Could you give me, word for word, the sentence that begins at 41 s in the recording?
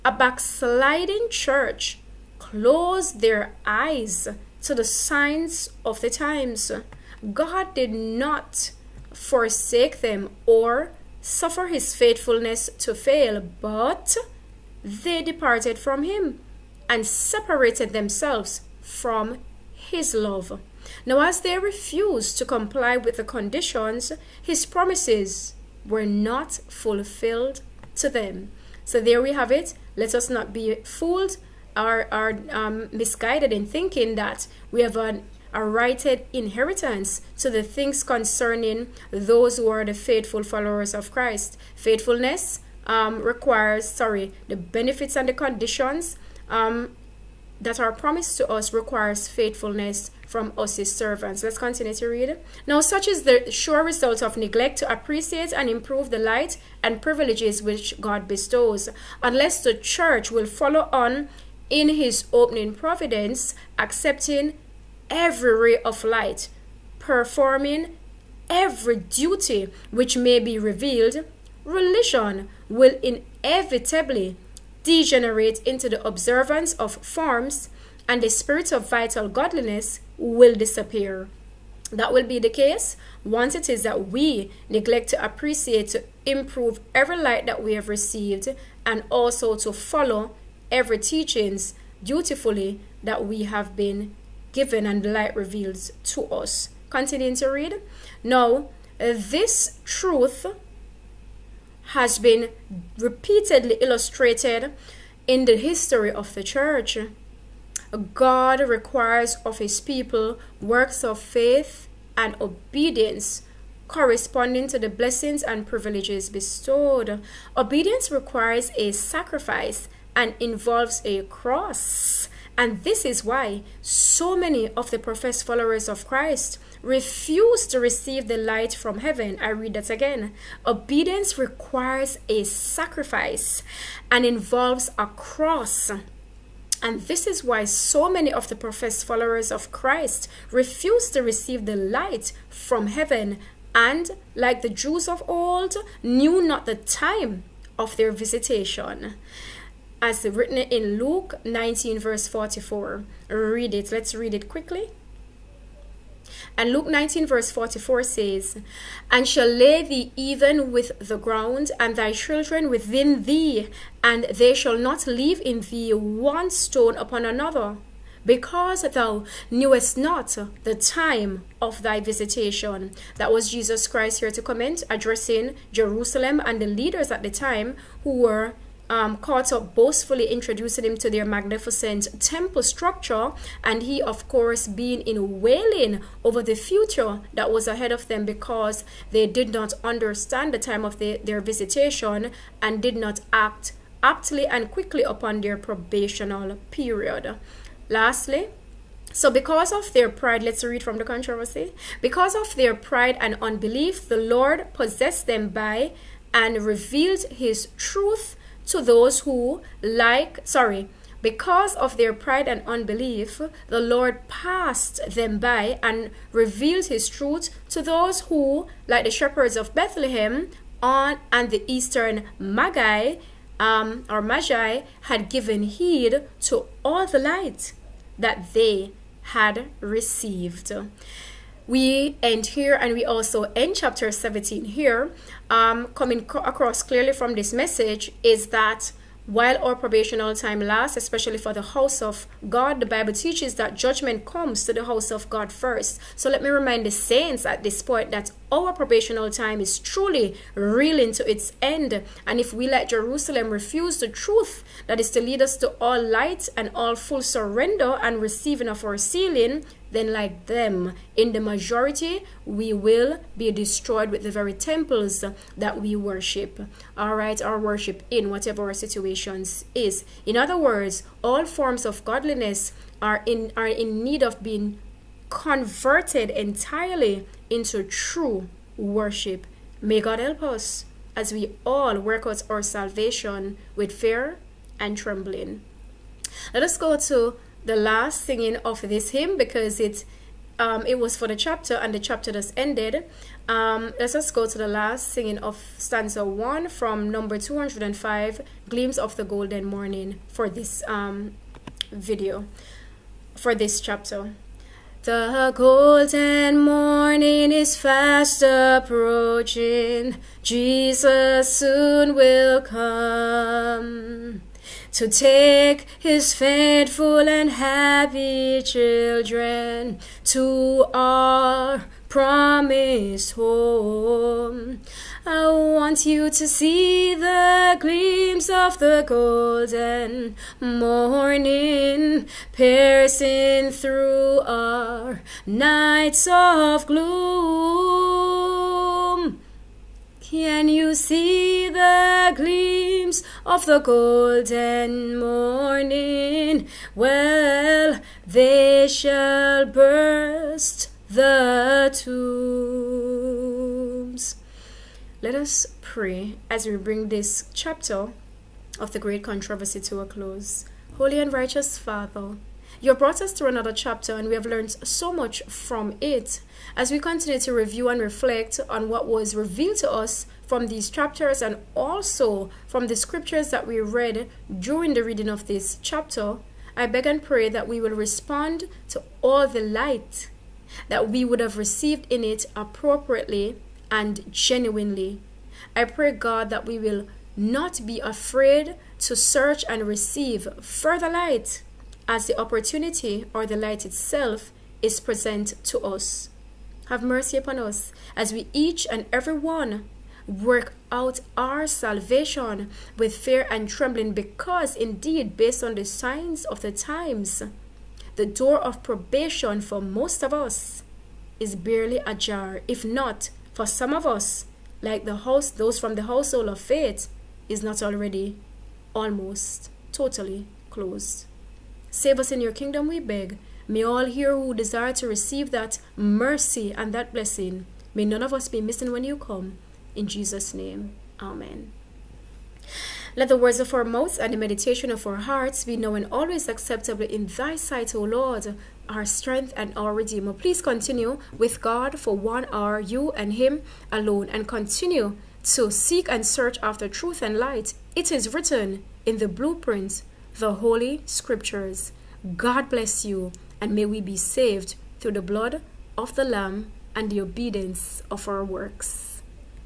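Faithfulness um, requires, sorry, the benefits and the conditions um, that our promise to us requires faithfulness from us his servants.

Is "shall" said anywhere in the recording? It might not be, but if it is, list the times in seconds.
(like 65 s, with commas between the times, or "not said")
159 s, 164 s, 348 s.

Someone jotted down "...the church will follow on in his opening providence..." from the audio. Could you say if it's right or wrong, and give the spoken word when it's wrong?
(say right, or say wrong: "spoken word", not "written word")
right.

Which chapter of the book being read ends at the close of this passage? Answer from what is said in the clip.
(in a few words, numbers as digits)
17.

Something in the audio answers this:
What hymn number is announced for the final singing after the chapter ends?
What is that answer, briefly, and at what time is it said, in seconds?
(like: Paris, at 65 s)
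205, at 297 s.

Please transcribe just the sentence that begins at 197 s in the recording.
Lastly, so because of their pride, let's read from the controversy.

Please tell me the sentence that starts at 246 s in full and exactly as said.
So let me remind the saints at this point that our probational time is truly reeling to its end.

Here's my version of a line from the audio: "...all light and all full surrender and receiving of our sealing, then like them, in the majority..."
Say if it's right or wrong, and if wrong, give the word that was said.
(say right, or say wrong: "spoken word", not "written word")
right.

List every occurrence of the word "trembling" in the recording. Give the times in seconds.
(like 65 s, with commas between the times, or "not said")
284 s, 403 s.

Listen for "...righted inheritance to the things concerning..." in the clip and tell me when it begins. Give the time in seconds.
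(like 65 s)
35 s.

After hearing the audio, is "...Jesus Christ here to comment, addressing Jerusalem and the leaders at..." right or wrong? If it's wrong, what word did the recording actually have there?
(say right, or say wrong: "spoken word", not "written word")
right.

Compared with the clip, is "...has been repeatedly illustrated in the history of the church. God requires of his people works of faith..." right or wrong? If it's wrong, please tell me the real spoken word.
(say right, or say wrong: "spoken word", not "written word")
right.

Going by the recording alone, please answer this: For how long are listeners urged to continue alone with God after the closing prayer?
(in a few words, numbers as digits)
One hour.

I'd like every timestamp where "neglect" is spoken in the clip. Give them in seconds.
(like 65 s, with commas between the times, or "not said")
54 s, 84 s.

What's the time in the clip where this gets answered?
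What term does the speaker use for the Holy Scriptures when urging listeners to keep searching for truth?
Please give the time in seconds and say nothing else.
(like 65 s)
449 s.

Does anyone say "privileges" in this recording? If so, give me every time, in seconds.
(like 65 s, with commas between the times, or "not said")
57 s, 115 s.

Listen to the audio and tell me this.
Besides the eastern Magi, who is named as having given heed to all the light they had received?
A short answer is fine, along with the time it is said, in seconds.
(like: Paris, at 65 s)
Shepherds of Bethlehem, at 219 s.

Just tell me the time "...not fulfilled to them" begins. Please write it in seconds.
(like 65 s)
26 s.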